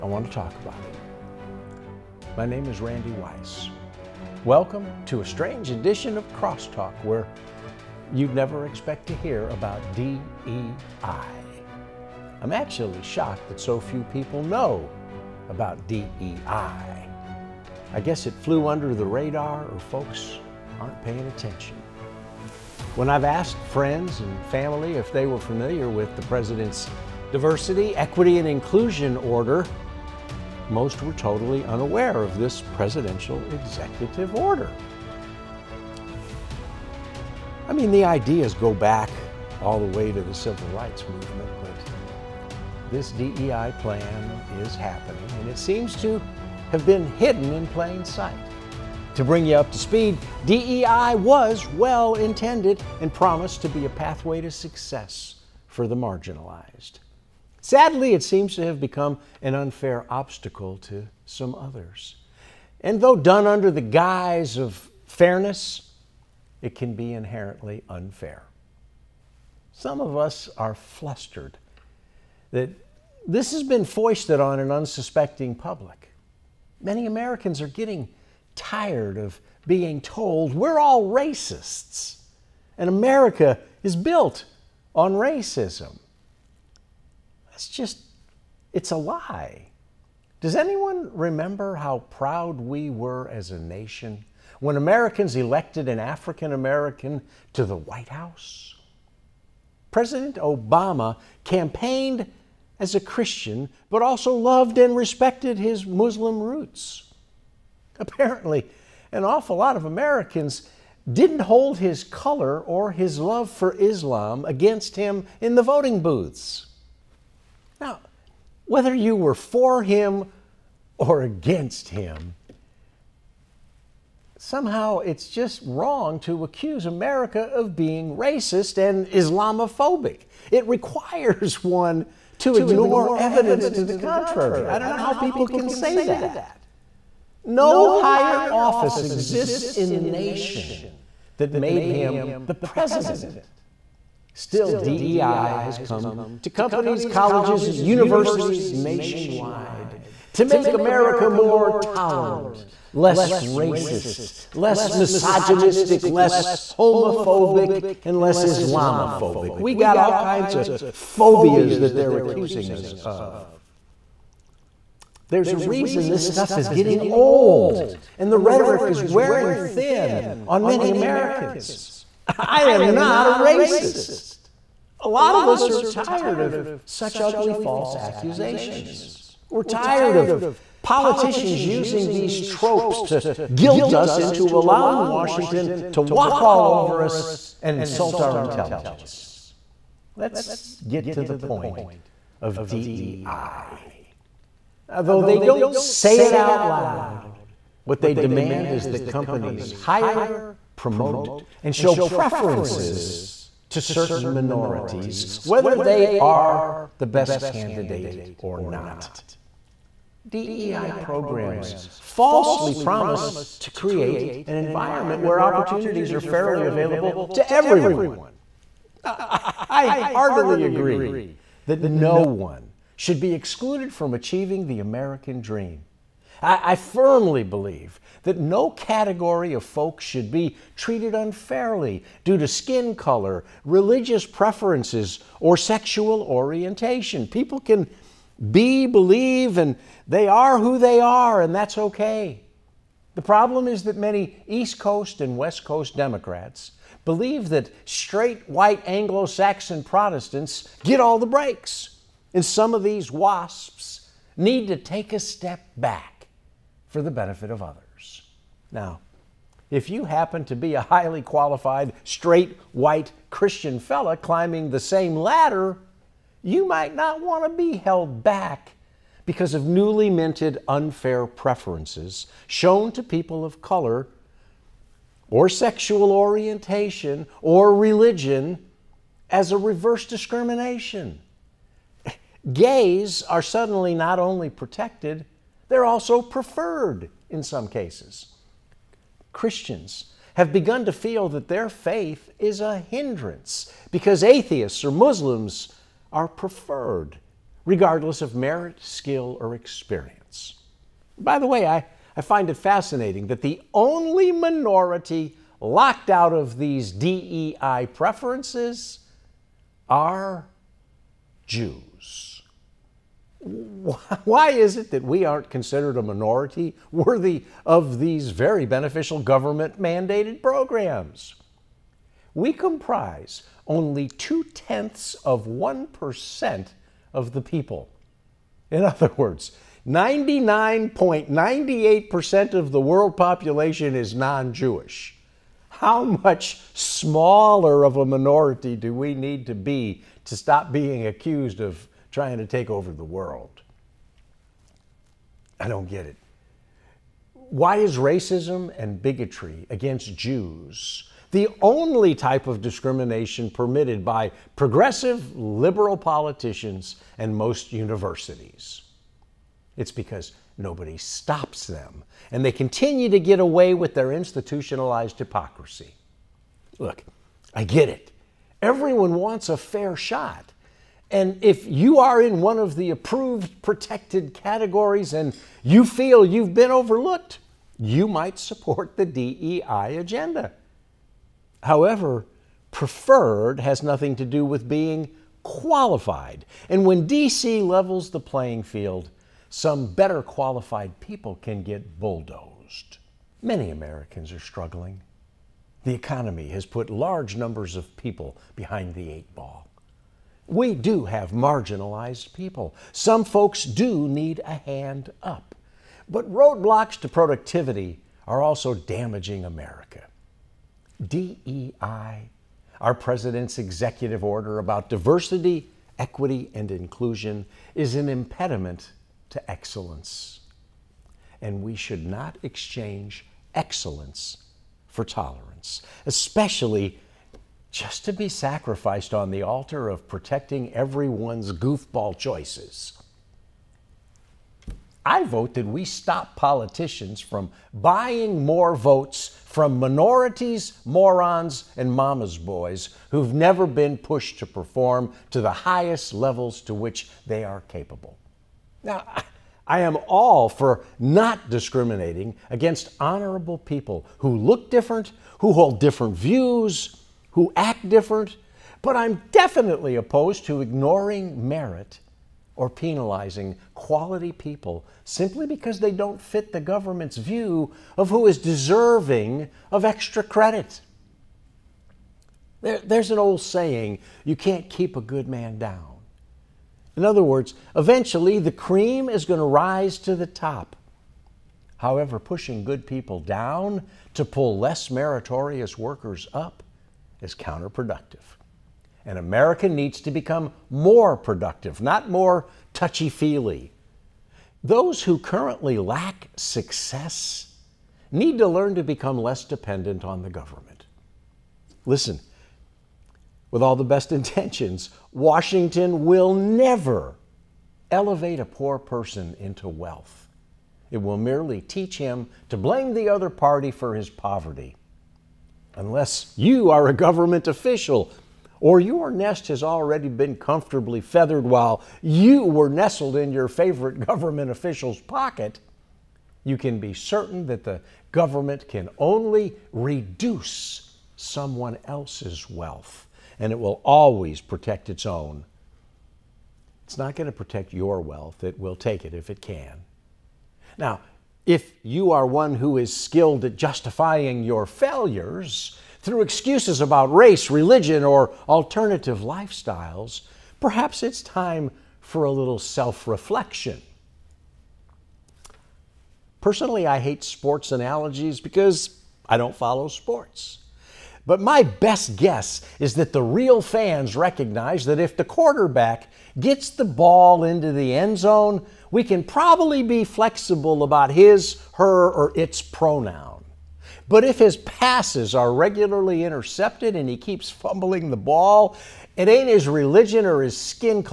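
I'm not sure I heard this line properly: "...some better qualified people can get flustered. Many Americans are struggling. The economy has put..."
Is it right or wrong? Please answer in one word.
wrong.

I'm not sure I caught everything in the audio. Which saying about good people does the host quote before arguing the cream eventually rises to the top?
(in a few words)
You can't keep a good man down.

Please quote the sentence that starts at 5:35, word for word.
How much smaller of a minority do we need to be to stop being accused of trying to take over the world.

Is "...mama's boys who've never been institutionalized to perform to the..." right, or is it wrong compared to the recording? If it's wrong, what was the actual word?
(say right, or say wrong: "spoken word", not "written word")
wrong: "pushed", not "institutionalized".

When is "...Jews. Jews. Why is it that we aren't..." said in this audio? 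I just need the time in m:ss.
5:11.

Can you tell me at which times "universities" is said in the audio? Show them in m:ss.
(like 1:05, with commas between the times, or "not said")
2:27, 5:57.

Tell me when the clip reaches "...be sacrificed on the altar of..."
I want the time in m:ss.
7:08.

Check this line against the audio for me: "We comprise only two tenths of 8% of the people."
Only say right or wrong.
wrong.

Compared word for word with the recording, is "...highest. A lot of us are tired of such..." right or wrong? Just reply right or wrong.
wrong.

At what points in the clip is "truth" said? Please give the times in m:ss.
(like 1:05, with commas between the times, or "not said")
not said.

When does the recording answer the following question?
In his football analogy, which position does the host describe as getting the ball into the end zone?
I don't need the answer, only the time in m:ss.
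9:25.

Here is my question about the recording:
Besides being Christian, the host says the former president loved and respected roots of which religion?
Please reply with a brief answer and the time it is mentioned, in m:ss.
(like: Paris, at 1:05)
Muslim, at 1:45.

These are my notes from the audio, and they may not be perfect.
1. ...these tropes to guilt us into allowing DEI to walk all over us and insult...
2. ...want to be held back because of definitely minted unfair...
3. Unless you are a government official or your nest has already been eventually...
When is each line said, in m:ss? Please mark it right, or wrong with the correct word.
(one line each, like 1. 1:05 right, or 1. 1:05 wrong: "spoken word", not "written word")
1. 3:02 wrong: "Washington", not "DEI"
2. 4:27 wrong: "newly", not "definitely"
3. 8:35 wrong: "comfortably", not "eventually".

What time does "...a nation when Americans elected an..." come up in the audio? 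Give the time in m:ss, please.
1:33.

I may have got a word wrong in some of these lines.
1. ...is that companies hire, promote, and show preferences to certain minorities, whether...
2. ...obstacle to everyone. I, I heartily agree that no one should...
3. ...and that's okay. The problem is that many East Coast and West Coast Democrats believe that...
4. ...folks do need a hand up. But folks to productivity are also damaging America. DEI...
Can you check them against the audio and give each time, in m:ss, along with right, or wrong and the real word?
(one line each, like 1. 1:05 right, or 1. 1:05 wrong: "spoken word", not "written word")
1. 3:18 right
2. 3:36 wrong: "available", not "obstacle"
3. 4:01 right
4. 6:43 wrong: "roadblocks", not "folks".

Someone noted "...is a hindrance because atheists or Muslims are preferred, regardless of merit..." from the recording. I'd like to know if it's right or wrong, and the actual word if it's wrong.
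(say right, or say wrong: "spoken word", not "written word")
right.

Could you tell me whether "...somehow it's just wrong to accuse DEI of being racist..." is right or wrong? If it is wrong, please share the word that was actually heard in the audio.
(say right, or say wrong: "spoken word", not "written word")
wrong: "America", not "DEI".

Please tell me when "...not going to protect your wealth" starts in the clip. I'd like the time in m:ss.
8:56.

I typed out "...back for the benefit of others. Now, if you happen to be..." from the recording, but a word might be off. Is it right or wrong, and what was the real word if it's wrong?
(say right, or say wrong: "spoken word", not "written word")
right.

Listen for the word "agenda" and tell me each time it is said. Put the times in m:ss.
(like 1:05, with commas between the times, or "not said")
6:19.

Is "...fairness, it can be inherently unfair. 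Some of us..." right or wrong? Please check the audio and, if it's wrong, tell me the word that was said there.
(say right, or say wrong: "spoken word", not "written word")
right.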